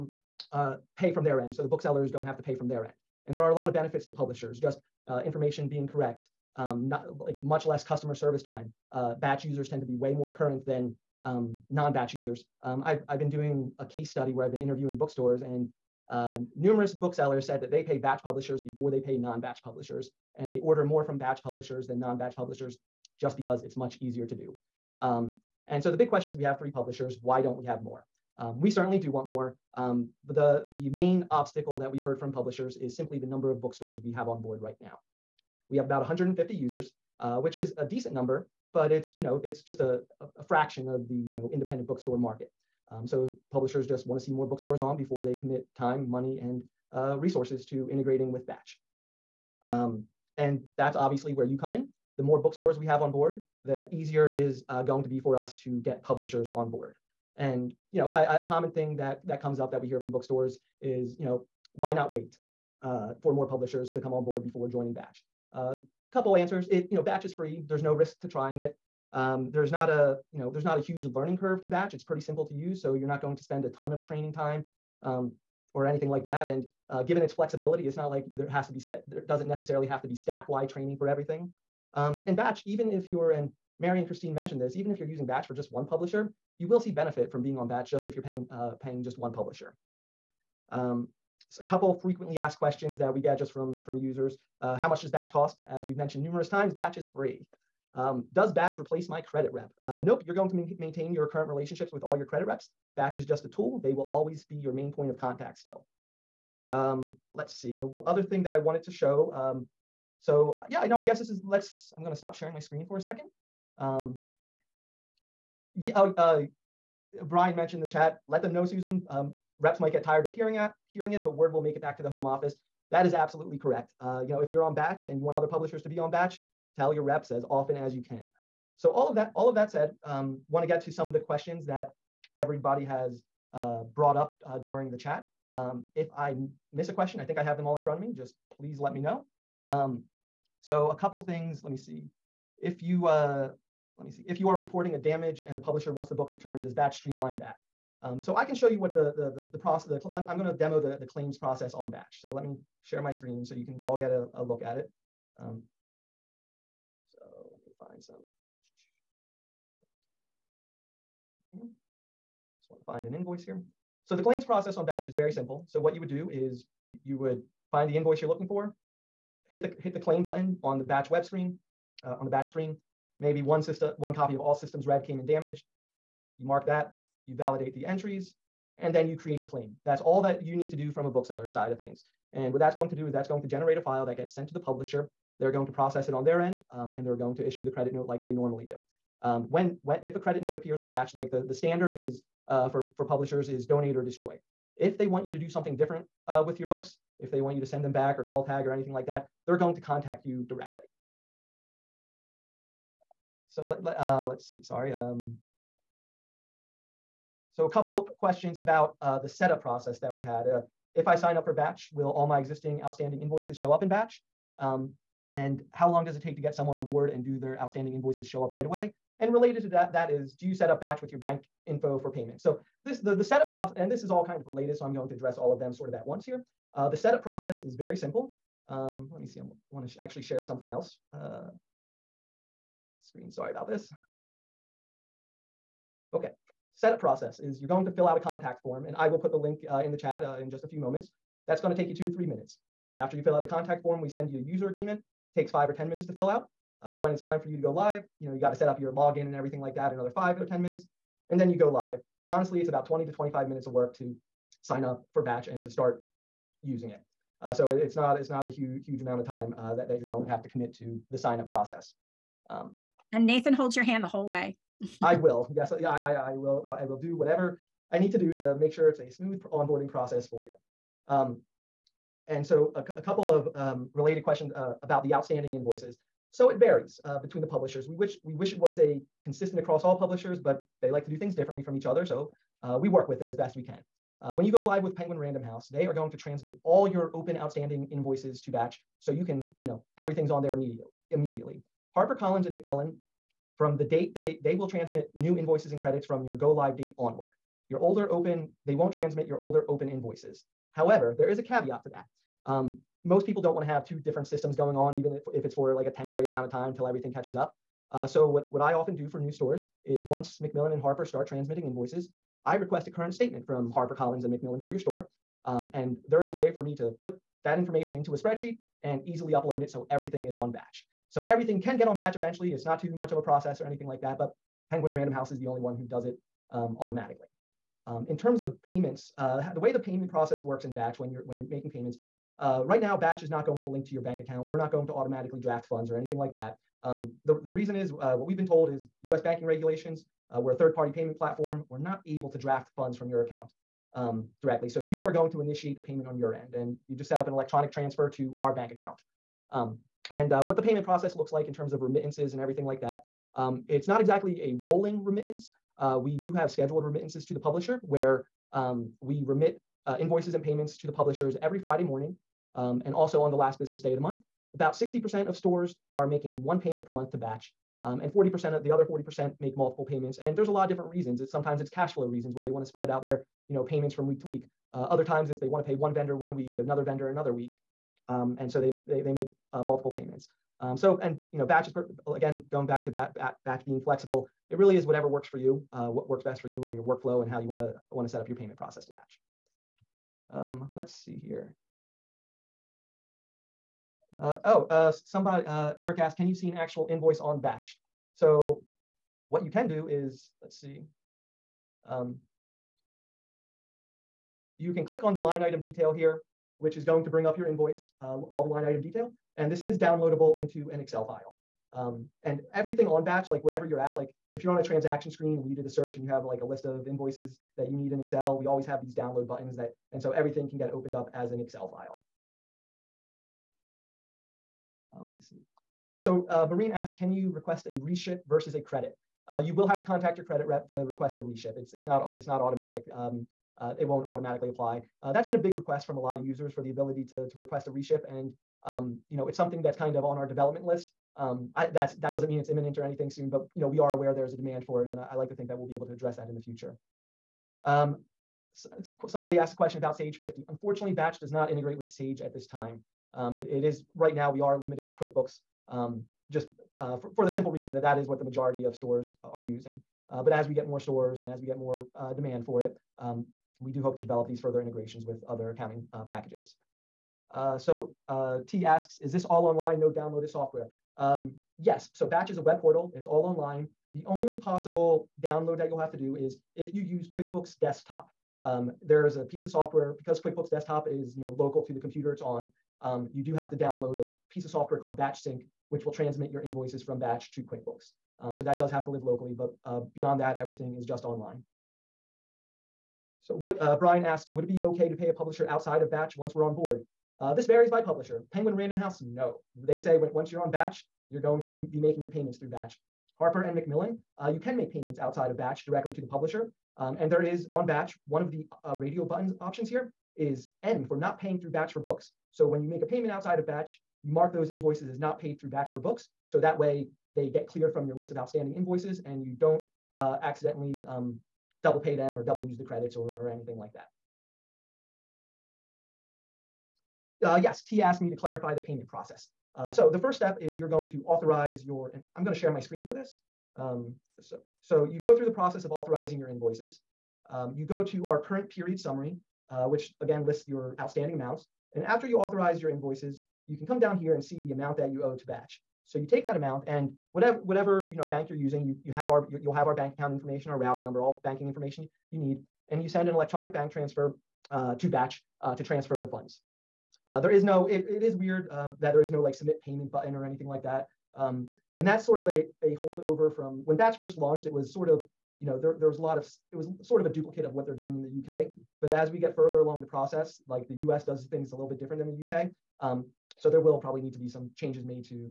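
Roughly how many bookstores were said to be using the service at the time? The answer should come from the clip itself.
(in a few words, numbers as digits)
150.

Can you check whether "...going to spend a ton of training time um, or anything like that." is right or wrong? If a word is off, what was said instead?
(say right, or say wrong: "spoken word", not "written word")
right.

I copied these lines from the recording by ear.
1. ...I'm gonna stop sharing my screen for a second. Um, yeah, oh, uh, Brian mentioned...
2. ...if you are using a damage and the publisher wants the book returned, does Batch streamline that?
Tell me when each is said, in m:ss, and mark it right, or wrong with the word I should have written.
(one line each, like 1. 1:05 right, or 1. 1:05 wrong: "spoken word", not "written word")
1. 1:51 right
2. 2:24 wrong: "reporting", not "using".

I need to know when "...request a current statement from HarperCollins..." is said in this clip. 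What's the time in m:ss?
5:12.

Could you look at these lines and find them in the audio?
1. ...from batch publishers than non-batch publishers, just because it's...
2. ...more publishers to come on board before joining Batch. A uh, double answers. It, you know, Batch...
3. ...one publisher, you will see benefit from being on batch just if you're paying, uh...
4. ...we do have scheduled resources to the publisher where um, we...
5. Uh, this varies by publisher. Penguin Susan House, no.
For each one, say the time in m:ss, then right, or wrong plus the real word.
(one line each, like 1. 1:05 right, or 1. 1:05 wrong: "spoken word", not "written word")
1. 0:21 right
2. 1:03 wrong: "couple", not "double"
3. 1:25 right
4. 5:55 wrong: "remittances", not "resources"
5. 8:17 wrong: "Random", not "Susan".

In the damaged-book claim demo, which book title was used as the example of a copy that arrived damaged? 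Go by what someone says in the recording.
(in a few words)
All Systems Red.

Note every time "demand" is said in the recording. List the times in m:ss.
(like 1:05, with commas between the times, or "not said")
7:24, 7:42.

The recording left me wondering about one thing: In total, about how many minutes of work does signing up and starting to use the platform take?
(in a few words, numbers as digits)
20 to 25 minutes.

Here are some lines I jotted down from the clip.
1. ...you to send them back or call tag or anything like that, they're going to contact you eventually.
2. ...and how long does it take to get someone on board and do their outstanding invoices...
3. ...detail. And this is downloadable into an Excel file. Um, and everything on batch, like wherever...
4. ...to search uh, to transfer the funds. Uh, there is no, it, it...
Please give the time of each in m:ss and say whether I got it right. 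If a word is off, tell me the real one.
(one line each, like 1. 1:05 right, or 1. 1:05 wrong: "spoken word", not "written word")
1. 3:17 wrong: "directly", not "eventually"
2. 3:35 right
3. 6:48 right
4. 9:14 wrong: "batch", not "search".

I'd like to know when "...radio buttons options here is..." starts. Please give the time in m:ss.
8:28.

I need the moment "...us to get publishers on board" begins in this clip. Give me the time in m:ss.
0:55.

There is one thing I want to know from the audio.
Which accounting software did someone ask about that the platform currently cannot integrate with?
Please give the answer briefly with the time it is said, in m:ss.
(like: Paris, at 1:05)
Sage 50, at 7:29.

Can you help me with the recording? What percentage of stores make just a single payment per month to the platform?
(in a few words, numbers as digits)
60%.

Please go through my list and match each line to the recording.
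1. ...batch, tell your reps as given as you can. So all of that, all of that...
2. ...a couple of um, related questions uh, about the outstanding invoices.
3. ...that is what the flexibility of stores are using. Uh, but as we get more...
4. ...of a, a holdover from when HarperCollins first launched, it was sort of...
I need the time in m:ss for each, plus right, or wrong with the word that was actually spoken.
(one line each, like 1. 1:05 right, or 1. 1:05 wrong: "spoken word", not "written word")
1. 2:06 wrong: "often", not "given"
2. 4:32 right
3. 7:37 wrong: "majority", not "flexibility"
4. 9:22 wrong: "Batch", not "HarperCollins".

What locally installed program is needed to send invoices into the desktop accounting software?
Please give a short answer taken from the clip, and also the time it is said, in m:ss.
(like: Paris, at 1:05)
Batch Sync, at 8:04.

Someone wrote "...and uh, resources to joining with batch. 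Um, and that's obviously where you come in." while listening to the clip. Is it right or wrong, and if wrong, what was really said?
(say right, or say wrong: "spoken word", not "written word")
wrong: "integrating", not "joining".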